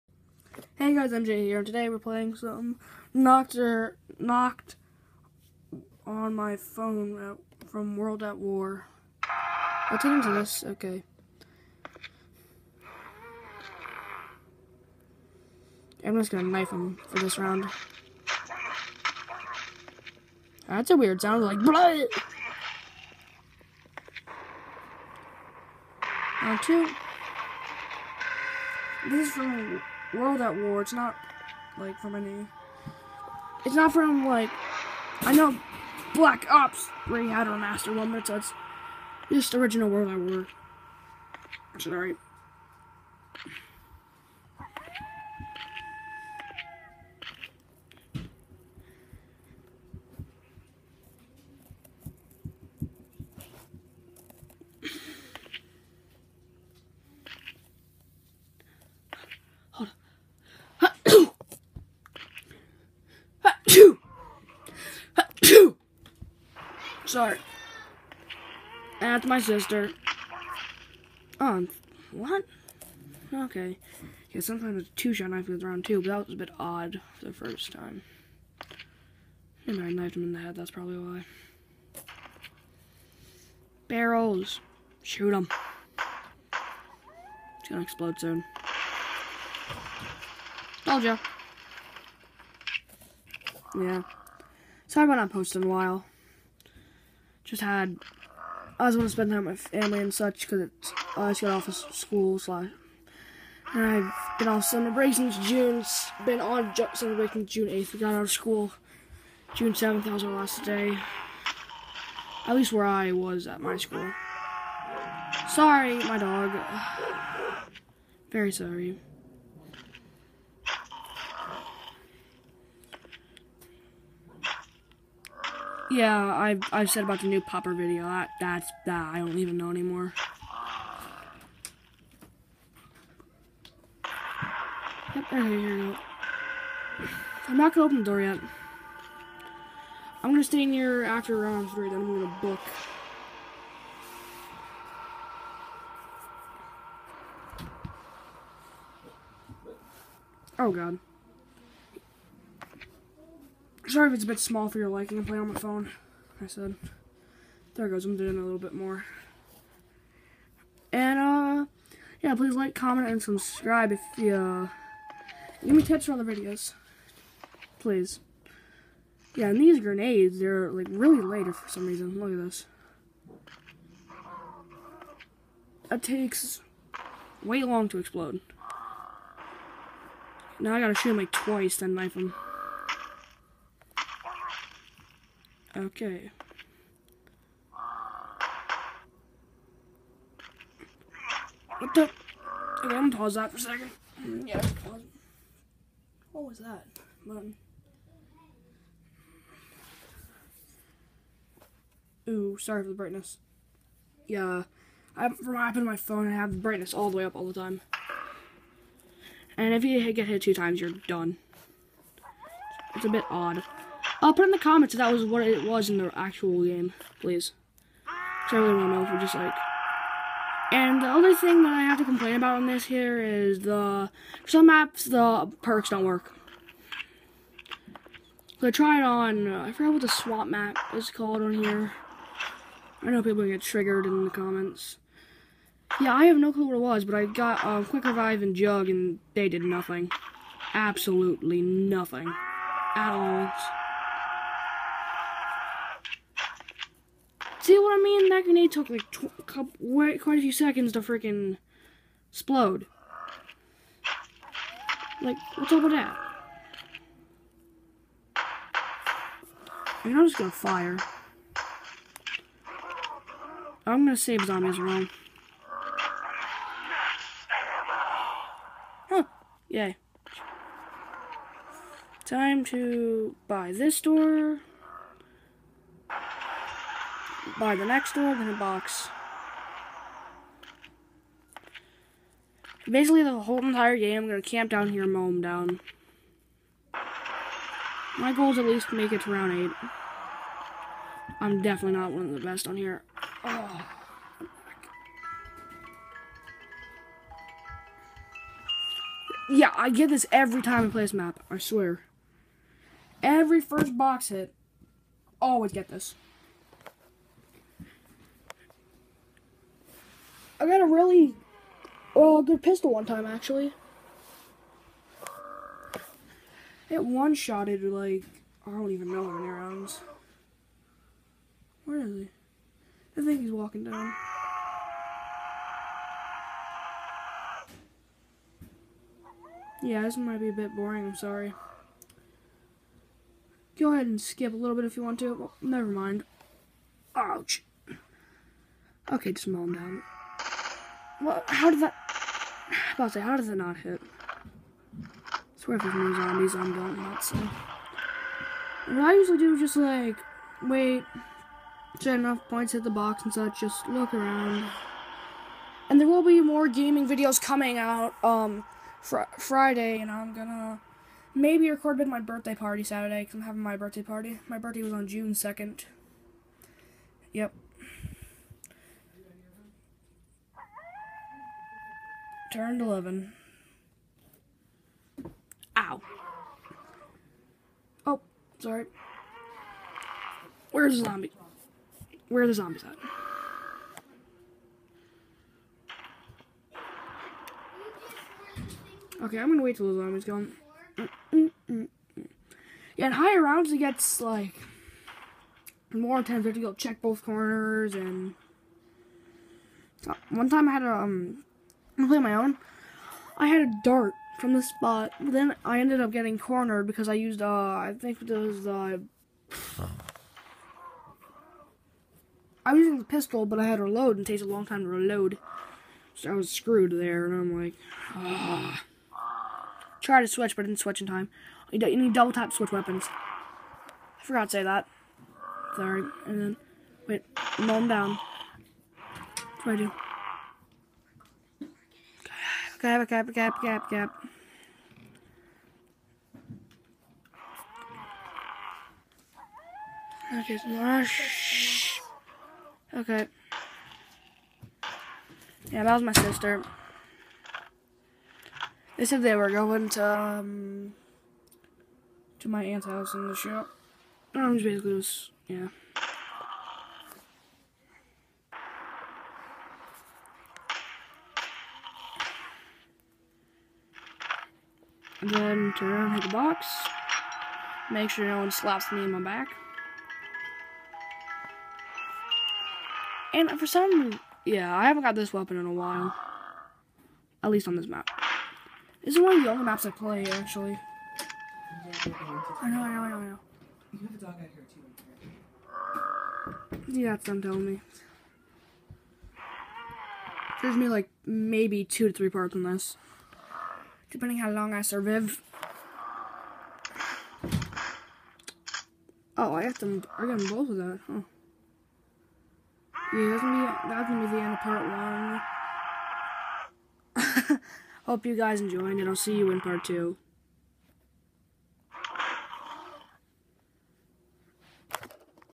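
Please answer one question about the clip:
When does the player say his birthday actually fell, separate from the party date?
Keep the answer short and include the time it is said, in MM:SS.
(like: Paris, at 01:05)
June 2nd, at 06:05.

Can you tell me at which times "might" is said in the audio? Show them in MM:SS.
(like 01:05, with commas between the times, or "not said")
05:30.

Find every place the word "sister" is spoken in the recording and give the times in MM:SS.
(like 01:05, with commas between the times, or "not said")
01:09, 07:26.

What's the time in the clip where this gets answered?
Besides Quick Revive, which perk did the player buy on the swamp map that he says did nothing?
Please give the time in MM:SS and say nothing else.
03:58.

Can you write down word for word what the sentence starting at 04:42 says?
Basically, the whole entire game, I'm going to camp down here and mow them down.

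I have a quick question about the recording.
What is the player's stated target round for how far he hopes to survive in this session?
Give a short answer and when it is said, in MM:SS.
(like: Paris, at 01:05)
round 8, at 04:49.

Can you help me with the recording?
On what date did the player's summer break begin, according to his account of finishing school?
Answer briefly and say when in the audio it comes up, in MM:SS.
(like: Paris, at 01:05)
June 8th, at 01:47.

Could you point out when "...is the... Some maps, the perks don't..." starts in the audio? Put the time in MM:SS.
03:43.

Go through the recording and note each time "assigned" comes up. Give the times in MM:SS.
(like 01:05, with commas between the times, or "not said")
not said.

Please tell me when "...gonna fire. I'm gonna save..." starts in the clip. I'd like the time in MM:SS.
04:20.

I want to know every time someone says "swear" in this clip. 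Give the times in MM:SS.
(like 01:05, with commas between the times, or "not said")
05:01, 05:45.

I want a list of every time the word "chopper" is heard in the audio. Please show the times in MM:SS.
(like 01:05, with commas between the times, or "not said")
not said.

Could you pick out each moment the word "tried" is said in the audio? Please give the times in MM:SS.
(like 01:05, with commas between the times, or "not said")
03:48, 07:00.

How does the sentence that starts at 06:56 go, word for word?
So I was screwed there, and I'm like, ah.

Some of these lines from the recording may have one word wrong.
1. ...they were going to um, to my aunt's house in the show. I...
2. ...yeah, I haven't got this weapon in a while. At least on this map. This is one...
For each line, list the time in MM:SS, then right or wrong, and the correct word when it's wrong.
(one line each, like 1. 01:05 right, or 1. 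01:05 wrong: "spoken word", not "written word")
1. 07:29 right
2. 07:54 right.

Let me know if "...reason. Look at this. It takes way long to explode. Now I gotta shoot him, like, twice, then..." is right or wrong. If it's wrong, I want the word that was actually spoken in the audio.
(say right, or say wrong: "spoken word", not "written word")
right.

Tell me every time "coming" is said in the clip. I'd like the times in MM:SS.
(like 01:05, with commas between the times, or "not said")
05:57.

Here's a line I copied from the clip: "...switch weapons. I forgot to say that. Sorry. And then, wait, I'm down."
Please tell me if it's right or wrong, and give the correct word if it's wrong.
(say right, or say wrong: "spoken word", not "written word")
right.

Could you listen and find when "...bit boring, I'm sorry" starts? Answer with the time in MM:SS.
05:30.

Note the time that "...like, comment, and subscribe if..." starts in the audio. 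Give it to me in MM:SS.
02:42.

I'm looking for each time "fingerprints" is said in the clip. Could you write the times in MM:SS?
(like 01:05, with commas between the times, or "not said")
not said.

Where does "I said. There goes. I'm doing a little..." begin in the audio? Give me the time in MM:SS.
02:36.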